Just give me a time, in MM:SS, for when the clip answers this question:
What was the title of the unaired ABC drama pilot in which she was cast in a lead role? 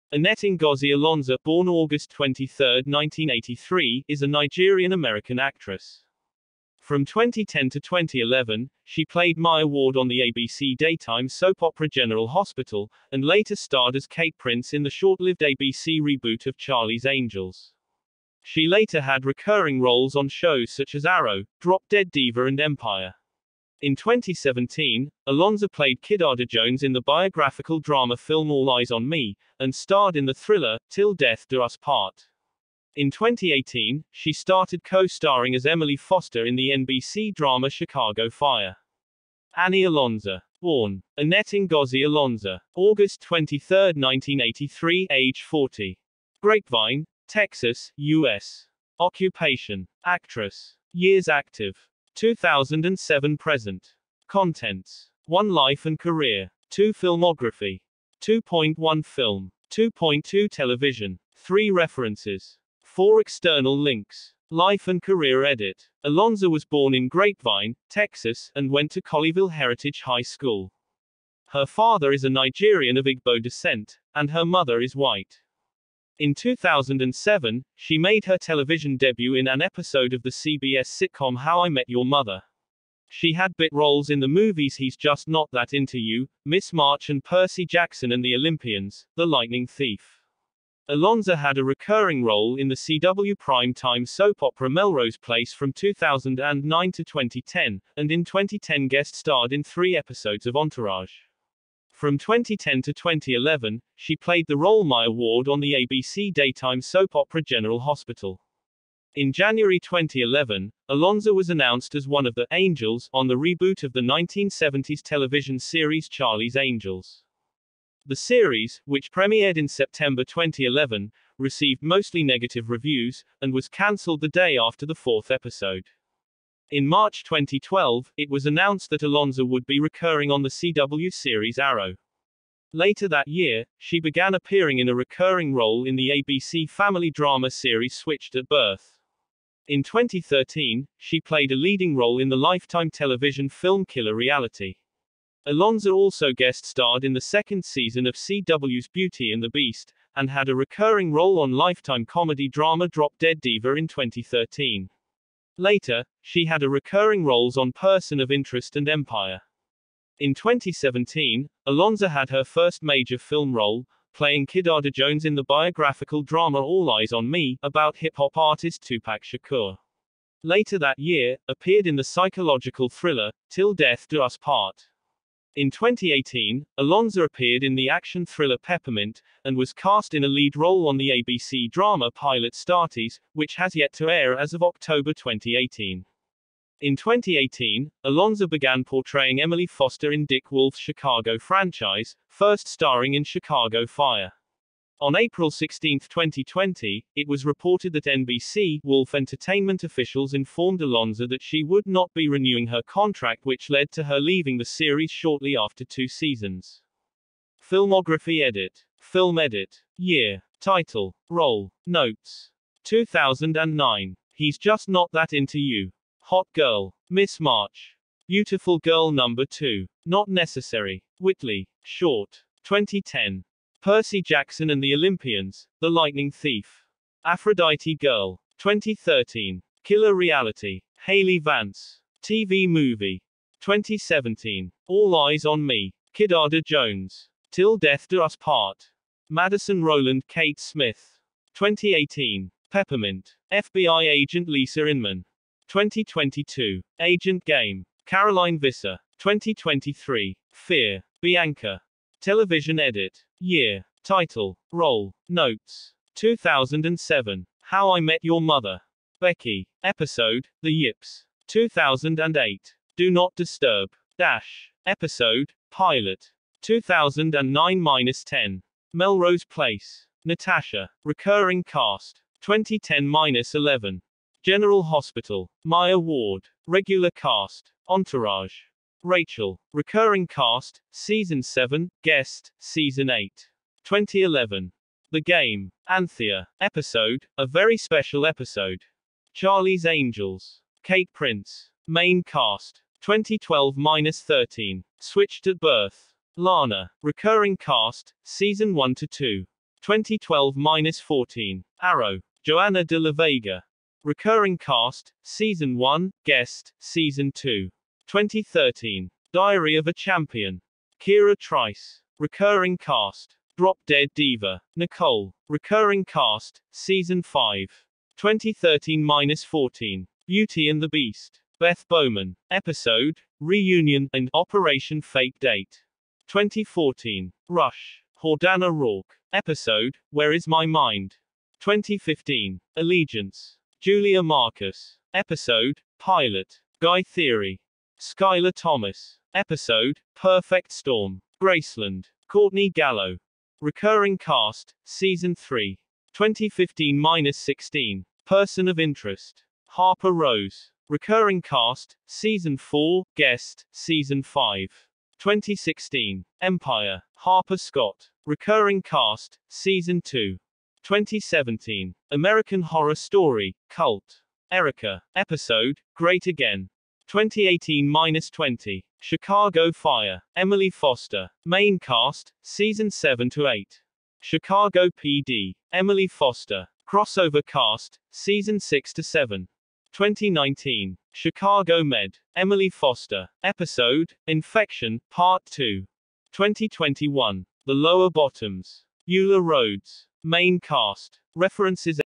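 03:02.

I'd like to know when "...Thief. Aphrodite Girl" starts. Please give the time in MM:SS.
03:46.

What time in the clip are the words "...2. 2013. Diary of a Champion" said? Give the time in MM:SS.
05:07.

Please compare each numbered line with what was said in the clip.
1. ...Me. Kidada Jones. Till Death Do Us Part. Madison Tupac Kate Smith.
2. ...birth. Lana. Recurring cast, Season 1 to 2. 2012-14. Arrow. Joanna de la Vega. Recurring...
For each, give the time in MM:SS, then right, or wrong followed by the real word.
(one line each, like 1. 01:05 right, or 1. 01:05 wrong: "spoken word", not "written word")
1. 03:55 wrong: "Rowland", not "Tupac"
2. 04:55 right.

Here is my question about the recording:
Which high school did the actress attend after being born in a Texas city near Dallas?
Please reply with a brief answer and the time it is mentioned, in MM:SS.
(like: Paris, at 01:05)
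Colleyville Heritage High School, at 01:09.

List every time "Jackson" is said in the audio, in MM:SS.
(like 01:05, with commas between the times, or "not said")
01:27, 03:44.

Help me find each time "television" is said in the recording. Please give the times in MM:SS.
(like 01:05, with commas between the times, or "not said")
01:00, 01:18, 01:55, 02:22, 04:12.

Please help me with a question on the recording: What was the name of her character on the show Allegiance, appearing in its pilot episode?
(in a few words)
Julia Marcus.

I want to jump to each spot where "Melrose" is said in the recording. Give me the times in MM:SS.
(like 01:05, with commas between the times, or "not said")
01:34, 04:28.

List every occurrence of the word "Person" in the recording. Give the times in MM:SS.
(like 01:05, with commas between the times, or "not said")
02:37, 05:48.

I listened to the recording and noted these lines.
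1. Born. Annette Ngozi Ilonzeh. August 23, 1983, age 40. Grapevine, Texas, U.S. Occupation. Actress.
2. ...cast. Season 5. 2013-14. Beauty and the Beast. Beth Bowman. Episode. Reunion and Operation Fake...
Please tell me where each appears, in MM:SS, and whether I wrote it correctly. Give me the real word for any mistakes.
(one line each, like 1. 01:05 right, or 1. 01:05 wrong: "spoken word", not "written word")
1. 00:40 right
2. 05:16 right.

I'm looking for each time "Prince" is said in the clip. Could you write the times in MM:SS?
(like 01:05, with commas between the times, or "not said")
00:14, 04:51.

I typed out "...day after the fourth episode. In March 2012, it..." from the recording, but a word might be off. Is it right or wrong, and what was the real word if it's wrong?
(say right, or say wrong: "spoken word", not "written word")
right.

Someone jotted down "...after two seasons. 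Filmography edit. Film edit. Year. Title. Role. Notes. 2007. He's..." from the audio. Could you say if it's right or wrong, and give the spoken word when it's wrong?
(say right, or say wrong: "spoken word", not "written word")
wrong: "2009", not "2007".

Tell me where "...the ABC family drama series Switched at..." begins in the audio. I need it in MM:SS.
02:15.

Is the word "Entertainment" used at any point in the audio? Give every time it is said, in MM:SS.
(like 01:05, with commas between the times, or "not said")
03:19.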